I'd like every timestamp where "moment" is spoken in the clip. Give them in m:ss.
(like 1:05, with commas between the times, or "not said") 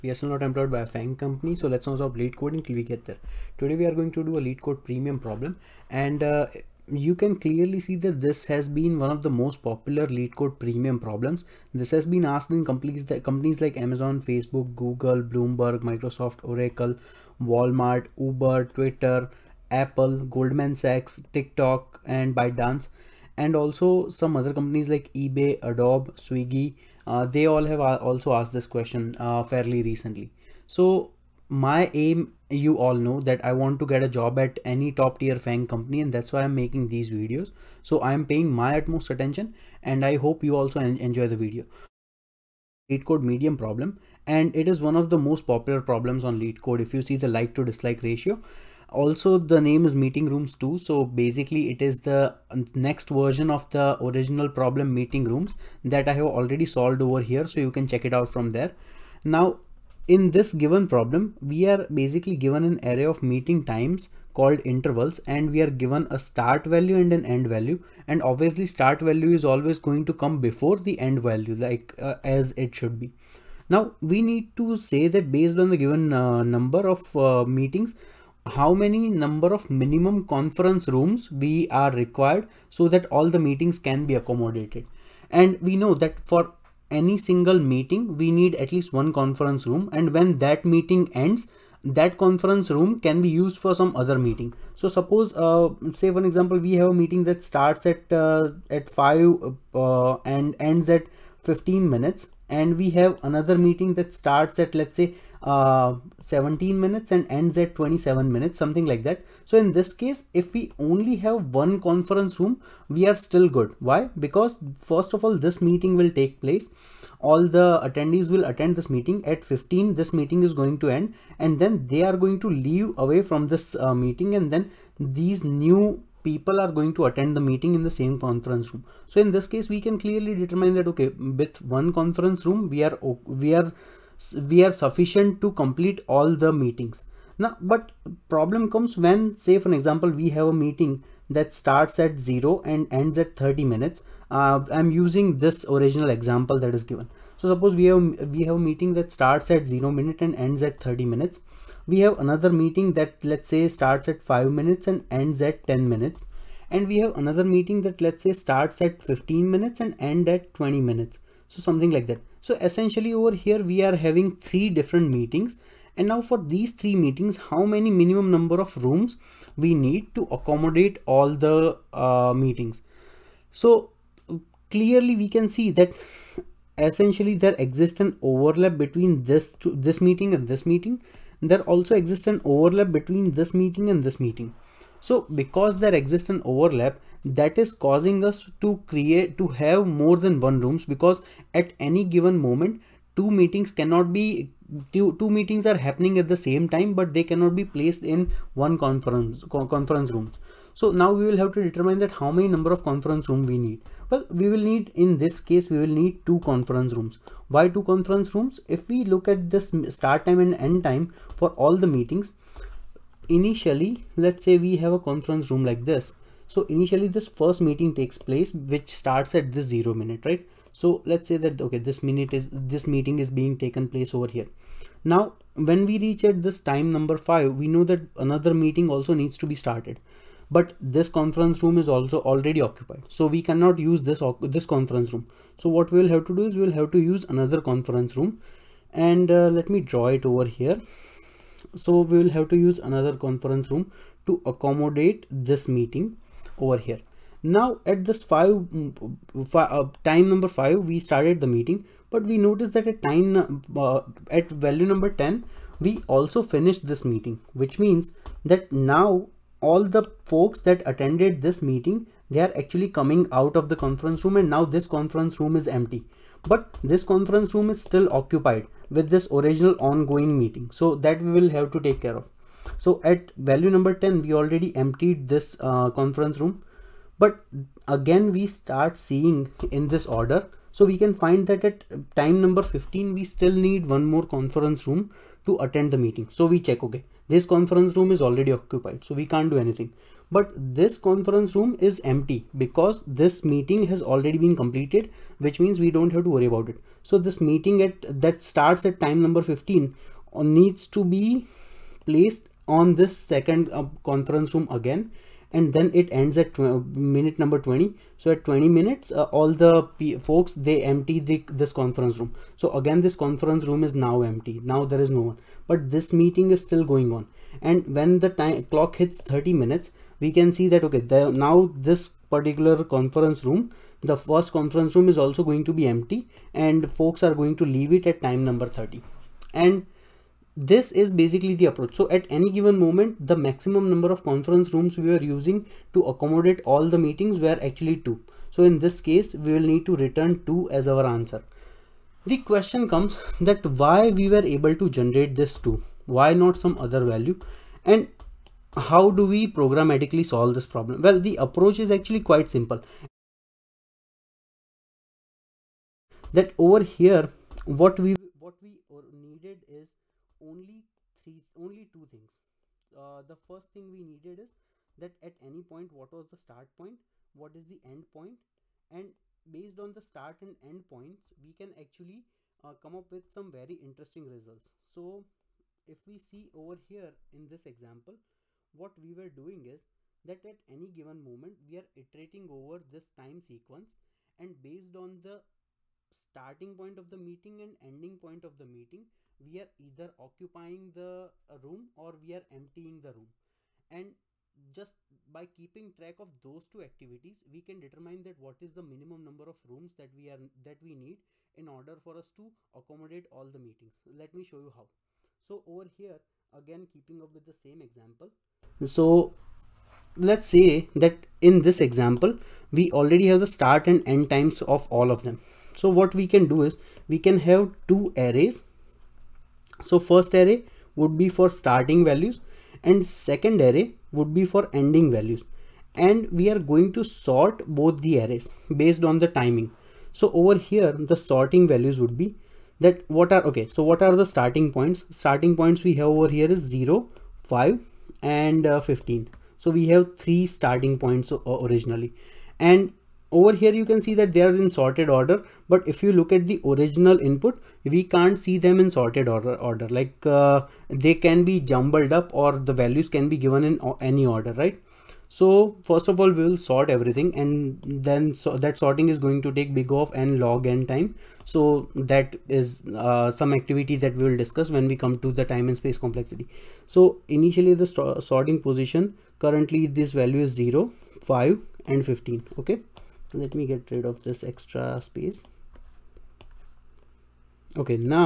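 3:12, 5:32, 6:21.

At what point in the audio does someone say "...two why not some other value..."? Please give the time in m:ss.
5:45.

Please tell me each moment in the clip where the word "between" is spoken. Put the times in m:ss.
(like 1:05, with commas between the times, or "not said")
2:58, 3:02.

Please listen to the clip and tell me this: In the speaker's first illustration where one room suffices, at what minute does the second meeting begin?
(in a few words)
17.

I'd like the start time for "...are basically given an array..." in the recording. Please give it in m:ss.
1:01.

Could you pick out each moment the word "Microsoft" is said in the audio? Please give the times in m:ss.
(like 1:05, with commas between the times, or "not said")
0:15.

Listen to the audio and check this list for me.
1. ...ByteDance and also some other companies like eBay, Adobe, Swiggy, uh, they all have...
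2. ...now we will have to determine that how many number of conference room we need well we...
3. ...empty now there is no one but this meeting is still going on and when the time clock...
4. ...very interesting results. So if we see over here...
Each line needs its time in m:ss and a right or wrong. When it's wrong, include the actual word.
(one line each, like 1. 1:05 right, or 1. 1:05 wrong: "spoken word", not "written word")
1. 0:22 right
2. 3:20 right
3. 5:14 right
4. 6:13 right.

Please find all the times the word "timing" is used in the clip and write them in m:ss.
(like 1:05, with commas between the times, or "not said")
7:09.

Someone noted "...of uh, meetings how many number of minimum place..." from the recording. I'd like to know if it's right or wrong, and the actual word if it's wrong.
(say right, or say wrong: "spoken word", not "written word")
wrong: "conference", not "place".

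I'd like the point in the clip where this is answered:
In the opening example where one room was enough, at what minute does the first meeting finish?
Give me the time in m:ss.
1:40.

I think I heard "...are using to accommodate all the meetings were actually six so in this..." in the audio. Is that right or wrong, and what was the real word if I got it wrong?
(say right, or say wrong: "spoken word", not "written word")
wrong: "two", not "six".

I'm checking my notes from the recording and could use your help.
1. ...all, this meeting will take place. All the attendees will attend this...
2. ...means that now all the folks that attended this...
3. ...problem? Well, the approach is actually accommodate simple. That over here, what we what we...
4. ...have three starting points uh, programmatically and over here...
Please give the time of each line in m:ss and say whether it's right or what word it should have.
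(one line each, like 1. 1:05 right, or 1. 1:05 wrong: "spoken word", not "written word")
1. 1:55 right
2. 4:17 right
3. 5:50 wrong: "quite", not "accommodate"
4. 7:19 wrong: "originally", not "programmatically".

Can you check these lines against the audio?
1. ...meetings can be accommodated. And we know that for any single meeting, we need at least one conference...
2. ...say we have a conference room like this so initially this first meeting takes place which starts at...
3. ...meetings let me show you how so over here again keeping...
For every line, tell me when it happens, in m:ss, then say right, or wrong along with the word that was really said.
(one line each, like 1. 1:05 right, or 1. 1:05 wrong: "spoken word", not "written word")
1. 1:23 right
2. 3:34 right
3. 6:43 right.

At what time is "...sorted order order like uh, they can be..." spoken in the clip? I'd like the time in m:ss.
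7:28.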